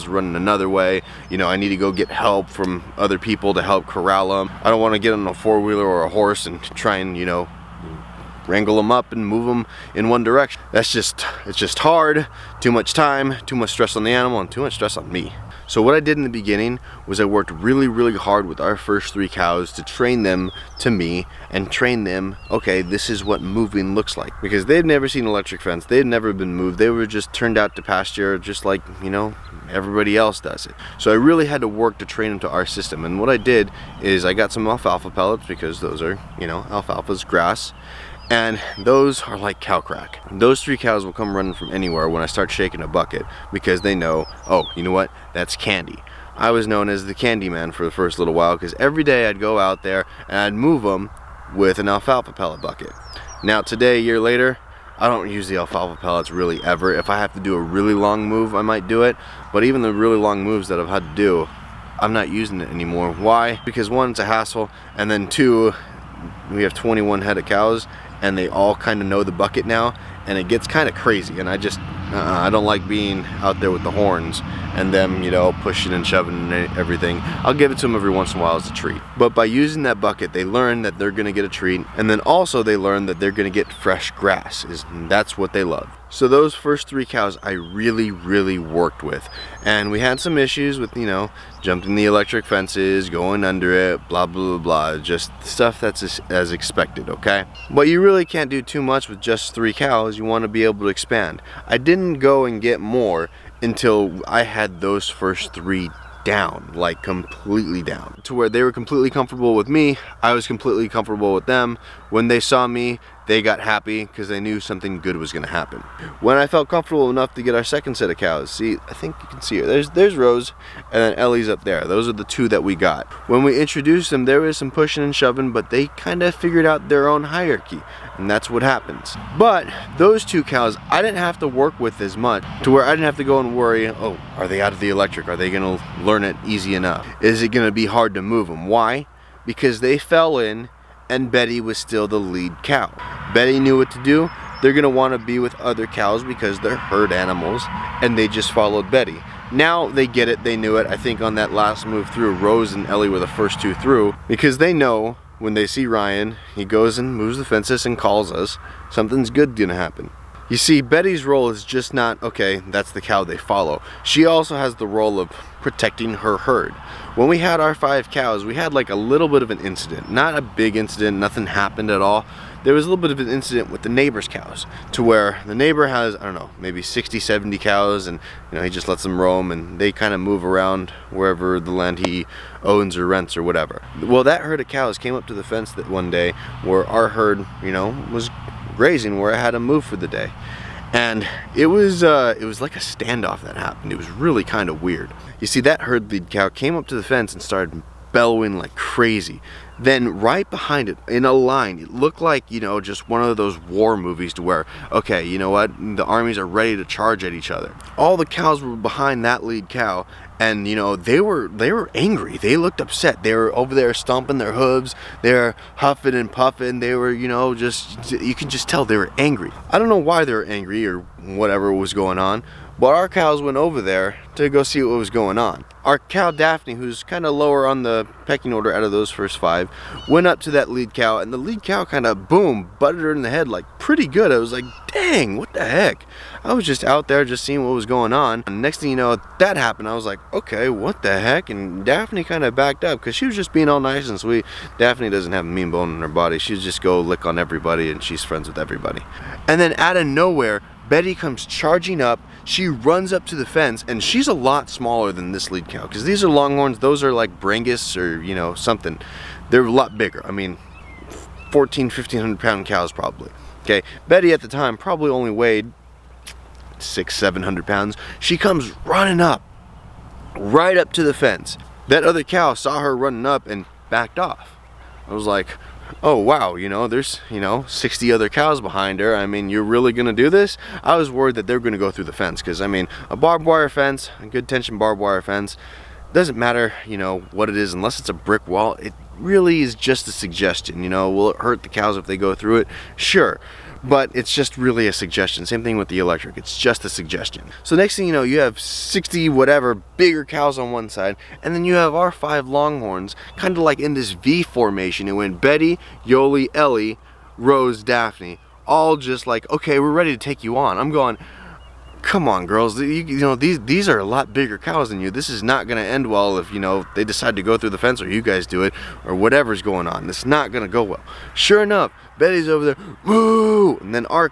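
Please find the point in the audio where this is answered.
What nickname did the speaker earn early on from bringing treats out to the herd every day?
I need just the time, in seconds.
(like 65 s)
47 s.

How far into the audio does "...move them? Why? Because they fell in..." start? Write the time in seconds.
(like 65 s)
138 s.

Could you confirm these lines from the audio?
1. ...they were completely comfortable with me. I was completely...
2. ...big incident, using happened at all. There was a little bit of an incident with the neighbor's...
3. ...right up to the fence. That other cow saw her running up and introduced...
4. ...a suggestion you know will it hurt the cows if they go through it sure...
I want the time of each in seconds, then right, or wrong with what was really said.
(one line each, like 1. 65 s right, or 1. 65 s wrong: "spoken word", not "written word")
1. 108 s right
2. 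170 s wrong: "nothing", not "using"
3. 270 s wrong: "backed", not "introduced"
4. 290 s right.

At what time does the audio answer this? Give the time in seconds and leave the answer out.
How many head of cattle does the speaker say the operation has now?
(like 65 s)
66 s.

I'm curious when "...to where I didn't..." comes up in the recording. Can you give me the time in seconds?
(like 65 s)
132 s.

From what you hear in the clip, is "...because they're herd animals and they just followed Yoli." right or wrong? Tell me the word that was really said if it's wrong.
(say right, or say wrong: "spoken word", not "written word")
wrong: "Betty", not "Yoli".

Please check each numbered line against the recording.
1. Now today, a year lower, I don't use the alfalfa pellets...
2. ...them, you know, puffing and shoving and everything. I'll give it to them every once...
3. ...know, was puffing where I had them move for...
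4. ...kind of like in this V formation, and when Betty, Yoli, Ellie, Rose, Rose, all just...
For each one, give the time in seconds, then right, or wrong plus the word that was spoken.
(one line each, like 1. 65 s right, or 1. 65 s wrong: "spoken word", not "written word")
1. 53 s wrong: "later", not "lower"
2. 74 s wrong: "pushing", not "puffing"
3. 187 s wrong: "grazing", not "puffing"
4. 303 s wrong: "Daphne", not "Rose".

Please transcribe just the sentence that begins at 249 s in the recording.
And then out of nowhere, Betty comes charging up.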